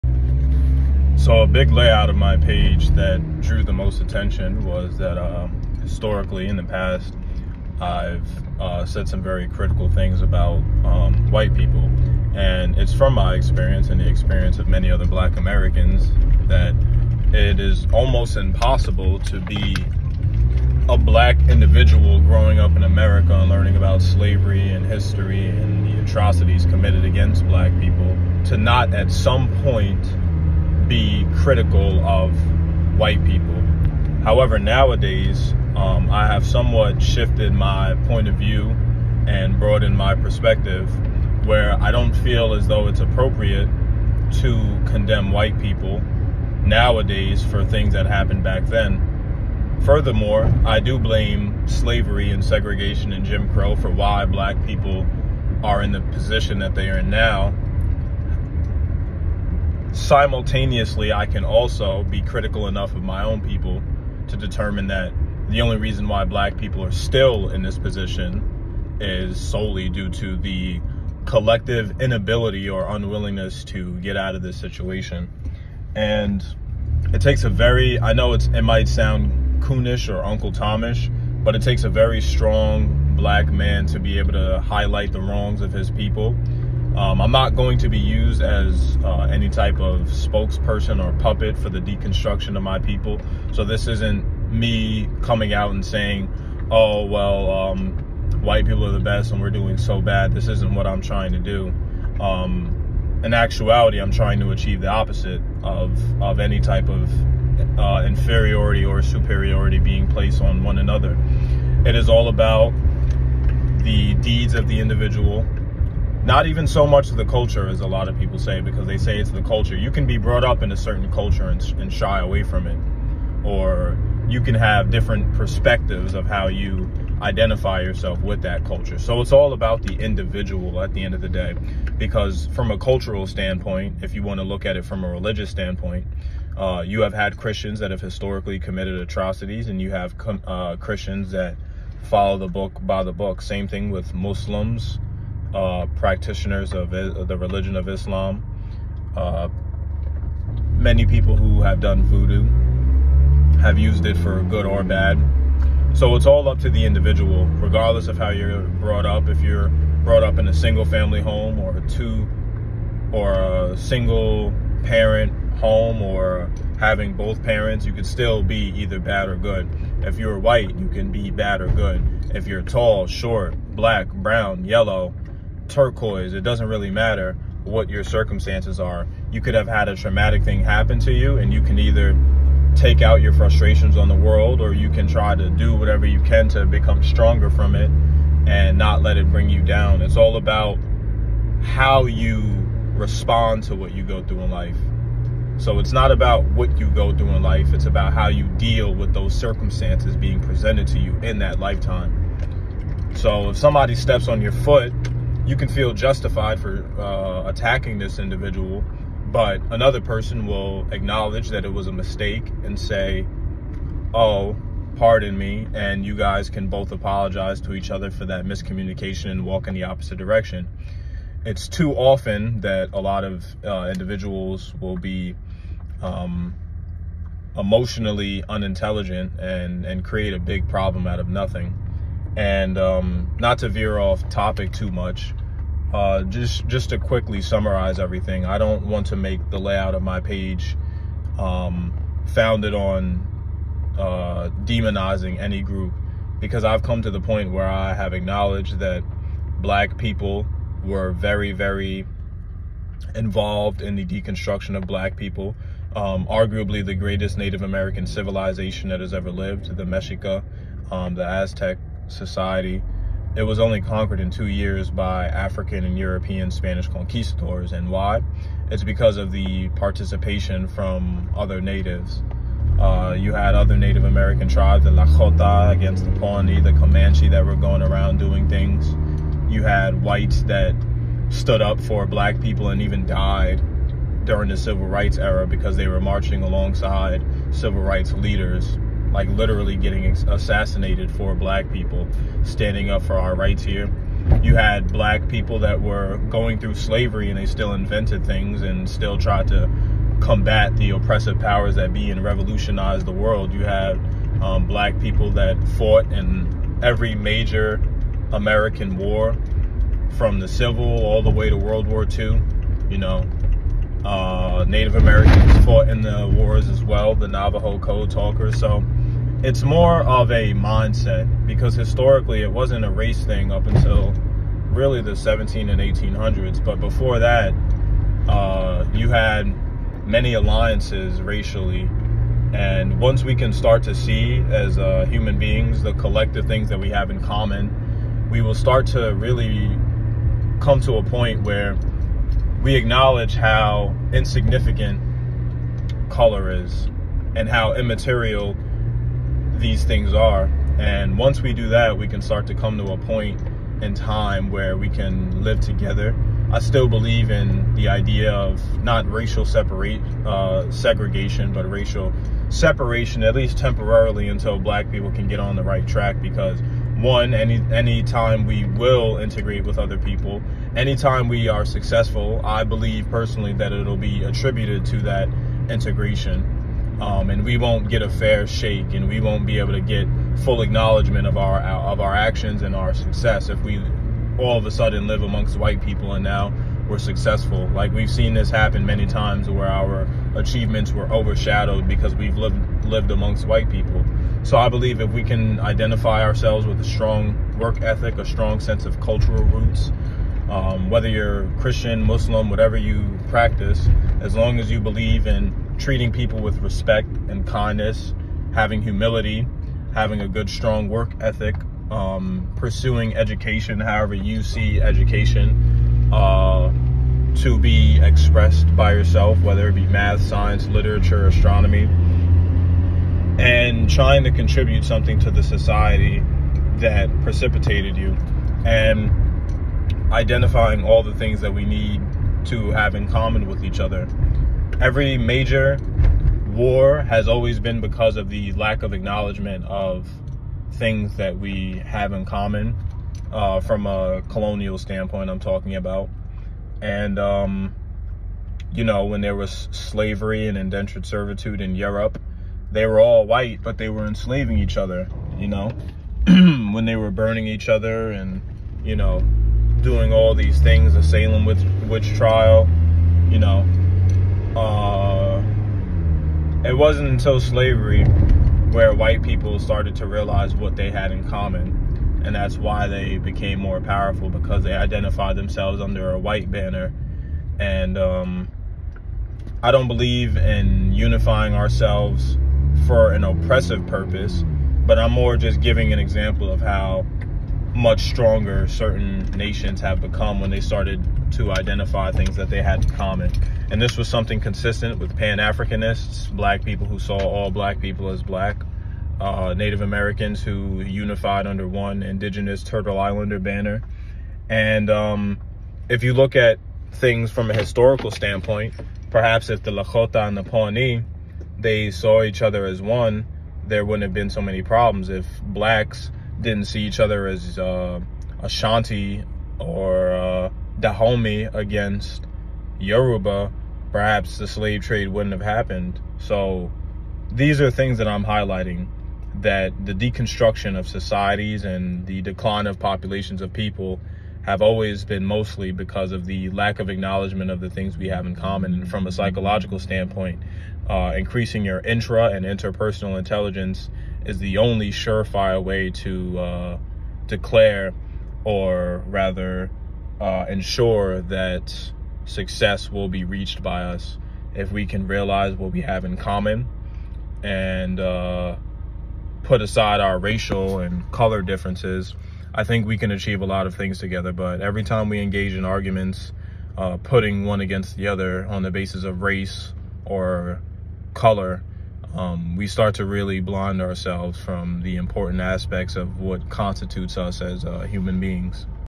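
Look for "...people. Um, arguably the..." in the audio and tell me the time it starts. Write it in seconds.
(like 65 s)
255 s.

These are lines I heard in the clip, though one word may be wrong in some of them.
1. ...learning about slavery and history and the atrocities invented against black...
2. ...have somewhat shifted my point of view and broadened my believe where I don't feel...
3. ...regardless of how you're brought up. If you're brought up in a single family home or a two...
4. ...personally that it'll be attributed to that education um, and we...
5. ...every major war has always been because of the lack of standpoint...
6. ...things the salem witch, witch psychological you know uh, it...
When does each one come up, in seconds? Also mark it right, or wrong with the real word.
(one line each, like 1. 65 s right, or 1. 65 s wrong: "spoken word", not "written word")
1. 23 s wrong: "committed", not "invented"
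2. 36 s wrong: "perspective", not "believe"
3. 157 s right
4. 373 s wrong: "integration", not "education"
5. 434 s wrong: "acknowledgement", not "standpoint"
6. 460 s wrong: "trial", not "psychological".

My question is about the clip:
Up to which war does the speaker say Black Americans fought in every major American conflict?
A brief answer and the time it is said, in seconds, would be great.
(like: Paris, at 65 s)
World War II, at 311 s.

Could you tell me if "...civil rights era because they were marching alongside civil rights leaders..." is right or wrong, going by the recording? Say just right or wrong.
right.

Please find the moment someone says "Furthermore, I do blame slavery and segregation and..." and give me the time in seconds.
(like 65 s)
49 s.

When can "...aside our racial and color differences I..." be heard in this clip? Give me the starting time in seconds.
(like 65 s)
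559 s.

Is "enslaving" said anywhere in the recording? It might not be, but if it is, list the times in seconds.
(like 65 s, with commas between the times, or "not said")
454 s.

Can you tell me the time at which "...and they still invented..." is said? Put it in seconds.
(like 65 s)
297 s.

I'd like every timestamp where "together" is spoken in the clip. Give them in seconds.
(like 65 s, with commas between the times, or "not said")
355 s, 563 s.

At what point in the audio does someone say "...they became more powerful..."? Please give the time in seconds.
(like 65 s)
472 s.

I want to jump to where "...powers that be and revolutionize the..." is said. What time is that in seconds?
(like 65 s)
301 s.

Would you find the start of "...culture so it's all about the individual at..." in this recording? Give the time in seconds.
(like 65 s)
128 s.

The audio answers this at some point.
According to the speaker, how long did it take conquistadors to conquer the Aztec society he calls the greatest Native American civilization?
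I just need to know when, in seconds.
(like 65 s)
264 s.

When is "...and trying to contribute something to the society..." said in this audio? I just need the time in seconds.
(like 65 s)
423 s.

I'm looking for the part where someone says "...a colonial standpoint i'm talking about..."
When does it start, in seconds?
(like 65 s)
443 s.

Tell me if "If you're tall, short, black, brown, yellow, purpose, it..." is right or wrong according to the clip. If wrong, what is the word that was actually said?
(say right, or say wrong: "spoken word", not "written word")
wrong: "turquoise", not "purpose".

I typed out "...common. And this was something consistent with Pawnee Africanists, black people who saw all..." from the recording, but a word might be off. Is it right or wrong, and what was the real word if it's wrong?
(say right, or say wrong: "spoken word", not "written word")
wrong: "Pan", not "Pawnee".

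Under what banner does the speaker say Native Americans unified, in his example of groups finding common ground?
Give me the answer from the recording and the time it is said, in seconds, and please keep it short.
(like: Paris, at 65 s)
Turtle Islander, at 502 s.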